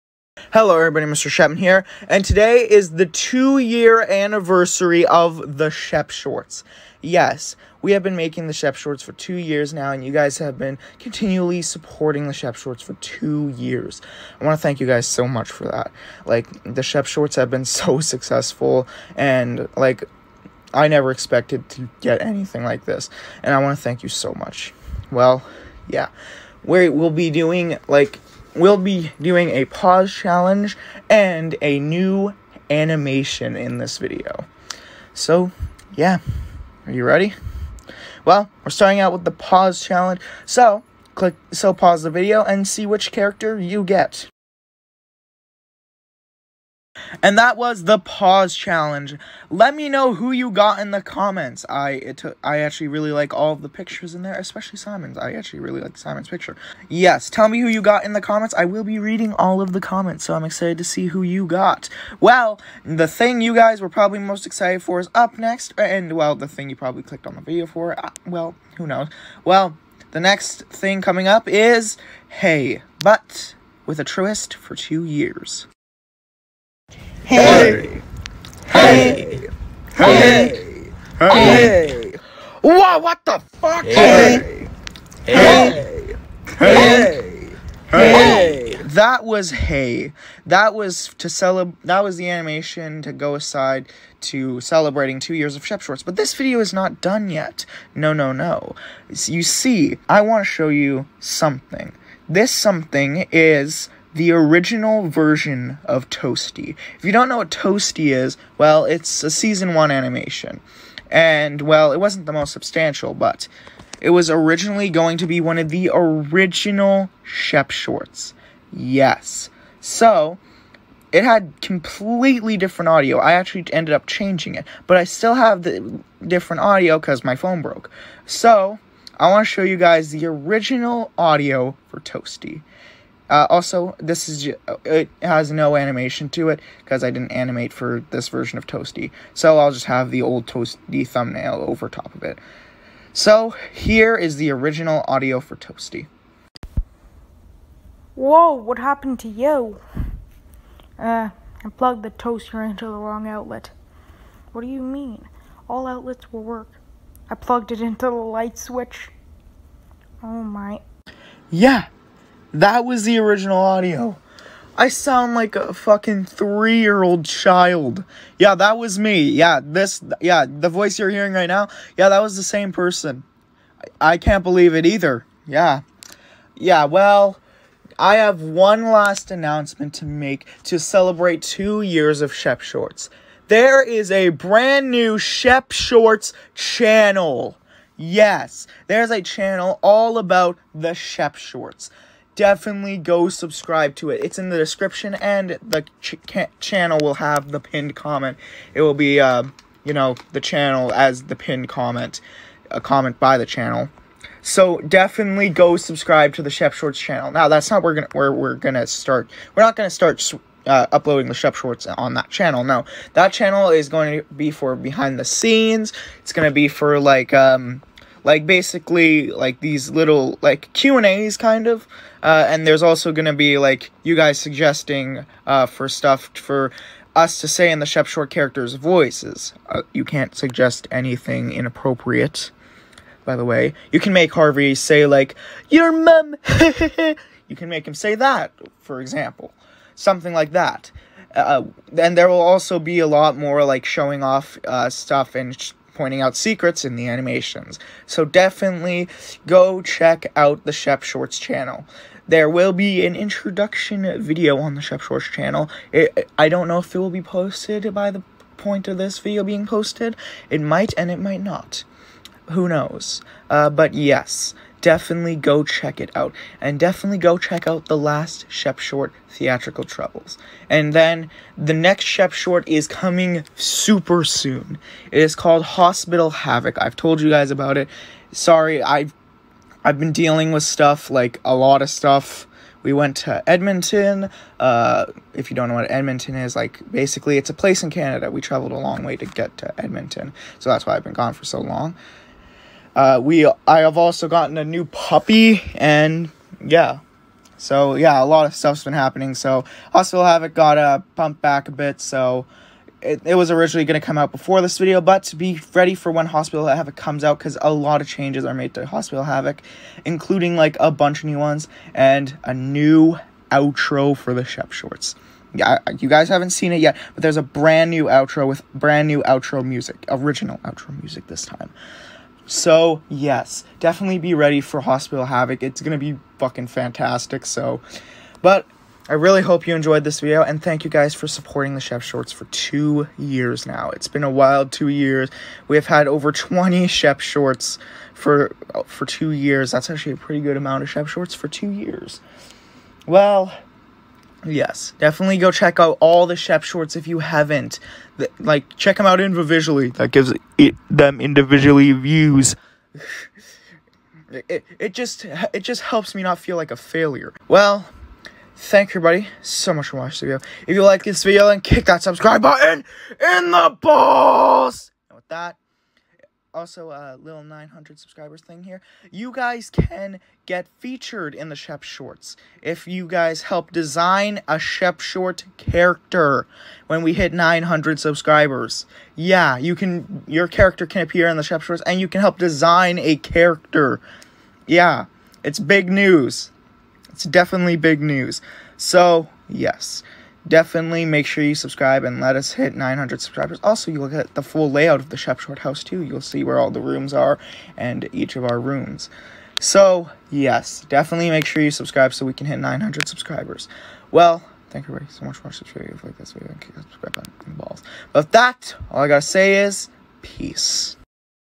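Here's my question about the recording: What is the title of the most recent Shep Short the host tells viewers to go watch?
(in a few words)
Theatrical Troubles.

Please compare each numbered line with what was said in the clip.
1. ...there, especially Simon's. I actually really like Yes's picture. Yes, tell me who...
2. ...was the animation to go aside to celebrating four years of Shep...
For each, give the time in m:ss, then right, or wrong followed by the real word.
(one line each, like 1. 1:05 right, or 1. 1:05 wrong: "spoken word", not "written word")
1. 0:54 wrong: "Simon", not "Yes"
2. 1:32 wrong: "two", not "four".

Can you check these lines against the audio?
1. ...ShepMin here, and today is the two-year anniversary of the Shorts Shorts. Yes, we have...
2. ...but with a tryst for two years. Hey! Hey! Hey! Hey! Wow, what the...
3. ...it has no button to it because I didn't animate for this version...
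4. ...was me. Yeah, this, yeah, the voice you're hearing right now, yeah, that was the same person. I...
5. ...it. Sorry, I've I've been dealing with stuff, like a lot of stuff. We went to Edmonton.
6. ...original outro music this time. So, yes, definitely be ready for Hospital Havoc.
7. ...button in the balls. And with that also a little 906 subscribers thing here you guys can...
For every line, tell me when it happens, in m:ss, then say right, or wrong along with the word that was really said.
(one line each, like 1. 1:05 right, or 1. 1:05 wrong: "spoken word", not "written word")
1. 0:01 wrong: "Shep", not "Shorts"
2. 1:13 right
3. 2:14 wrong: "animation", not "button"
4. 2:48 right
5. 4:37 right
6. 5:20 right
7. 6:02 wrong: "900", not "906".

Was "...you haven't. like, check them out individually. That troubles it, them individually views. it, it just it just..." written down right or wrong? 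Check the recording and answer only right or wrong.
wrong.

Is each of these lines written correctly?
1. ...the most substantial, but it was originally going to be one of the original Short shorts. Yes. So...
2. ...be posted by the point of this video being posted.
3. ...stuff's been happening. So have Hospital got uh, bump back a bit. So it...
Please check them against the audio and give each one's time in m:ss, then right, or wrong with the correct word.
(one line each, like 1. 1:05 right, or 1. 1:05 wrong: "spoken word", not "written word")
1. 1:52 wrong: "Shep", not "Short"
2. 4:17 right
3. 4:58 wrong: "Havoc", not "Hospital".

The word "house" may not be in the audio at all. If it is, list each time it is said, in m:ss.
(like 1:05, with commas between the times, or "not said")
6:35.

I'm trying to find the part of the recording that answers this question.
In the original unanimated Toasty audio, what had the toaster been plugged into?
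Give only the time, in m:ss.
2:38.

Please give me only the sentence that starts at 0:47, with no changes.
And that was the pause challenge.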